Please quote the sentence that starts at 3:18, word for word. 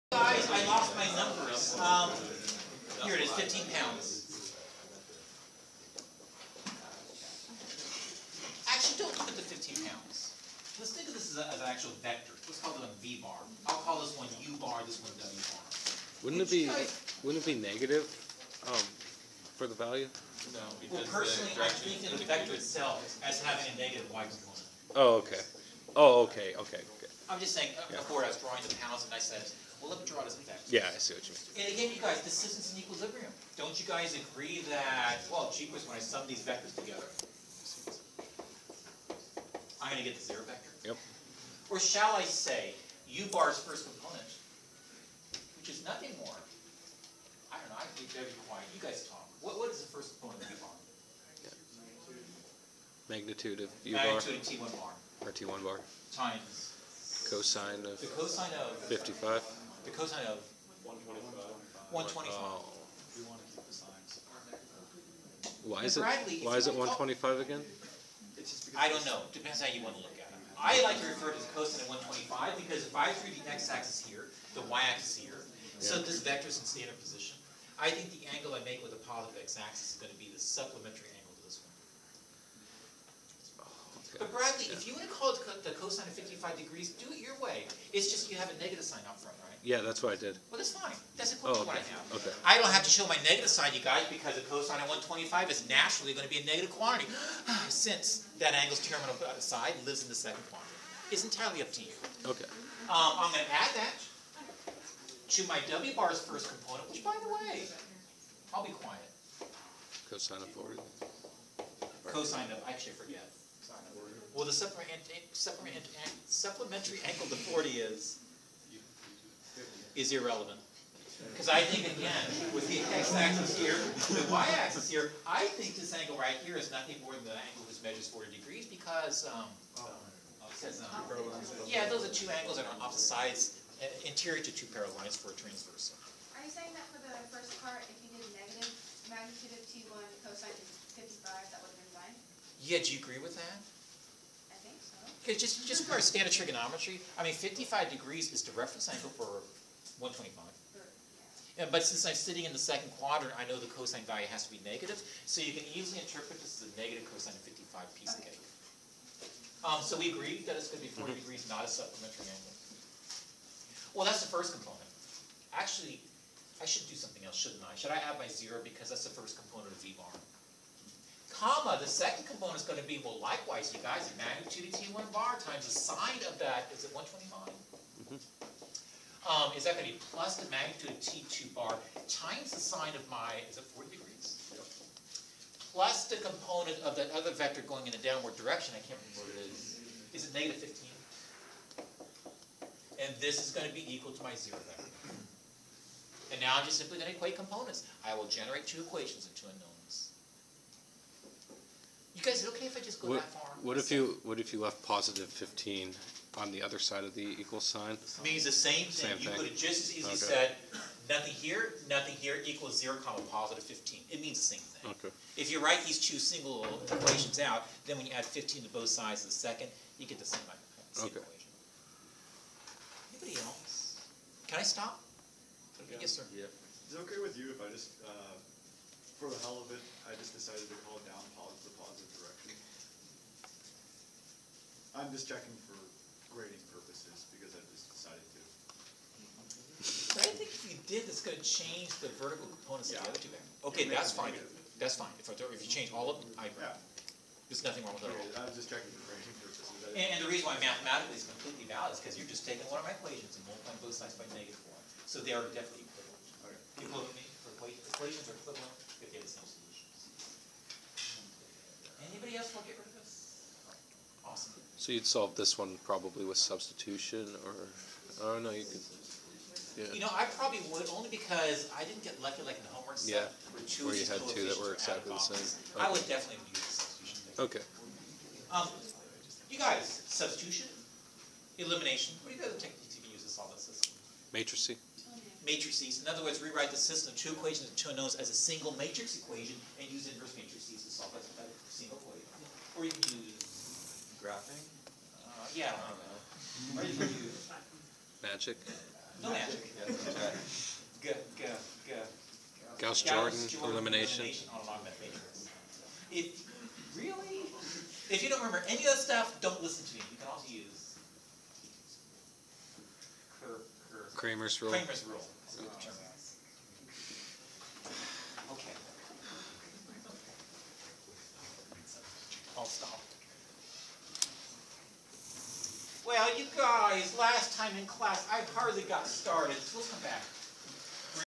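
I will generate two equations and two unknowns.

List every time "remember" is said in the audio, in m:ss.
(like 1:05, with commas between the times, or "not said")
3:09, 5:08.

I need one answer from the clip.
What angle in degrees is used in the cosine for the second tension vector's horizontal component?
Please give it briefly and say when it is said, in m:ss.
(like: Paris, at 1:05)
40, at 1:50.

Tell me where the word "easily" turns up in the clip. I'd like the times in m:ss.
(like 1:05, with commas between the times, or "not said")
2:35, 3:29.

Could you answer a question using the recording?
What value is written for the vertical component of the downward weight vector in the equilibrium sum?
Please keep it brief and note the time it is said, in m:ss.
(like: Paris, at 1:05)
-15, at 3:10.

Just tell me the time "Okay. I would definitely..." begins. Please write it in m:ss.
4:35.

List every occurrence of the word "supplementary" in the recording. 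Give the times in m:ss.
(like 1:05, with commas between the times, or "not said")
1:20, 1:54, 2:41.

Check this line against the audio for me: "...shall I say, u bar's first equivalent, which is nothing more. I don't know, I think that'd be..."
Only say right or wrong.
wrong.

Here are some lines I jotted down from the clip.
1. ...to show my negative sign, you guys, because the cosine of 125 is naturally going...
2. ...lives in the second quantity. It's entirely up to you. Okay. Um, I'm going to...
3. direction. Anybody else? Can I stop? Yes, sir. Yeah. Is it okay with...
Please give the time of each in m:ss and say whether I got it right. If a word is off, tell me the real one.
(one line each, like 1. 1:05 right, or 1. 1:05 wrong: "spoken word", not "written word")
1. 1:32 right
2. 1:39 right
3. 3:41 wrong: "equation", not "direction".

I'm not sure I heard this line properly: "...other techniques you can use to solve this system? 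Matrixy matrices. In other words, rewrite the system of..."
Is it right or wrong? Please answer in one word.
right.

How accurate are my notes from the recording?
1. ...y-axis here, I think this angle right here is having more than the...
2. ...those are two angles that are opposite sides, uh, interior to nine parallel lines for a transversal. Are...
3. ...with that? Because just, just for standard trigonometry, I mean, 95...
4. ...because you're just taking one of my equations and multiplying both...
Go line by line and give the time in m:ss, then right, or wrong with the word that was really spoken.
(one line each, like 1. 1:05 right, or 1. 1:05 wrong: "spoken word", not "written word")
1. 2:04 wrong: "nothing", not "having"
2. 2:11 wrong: "two", not "nine"
3. 2:23 wrong: "55", not "95"
4. 4:12 right.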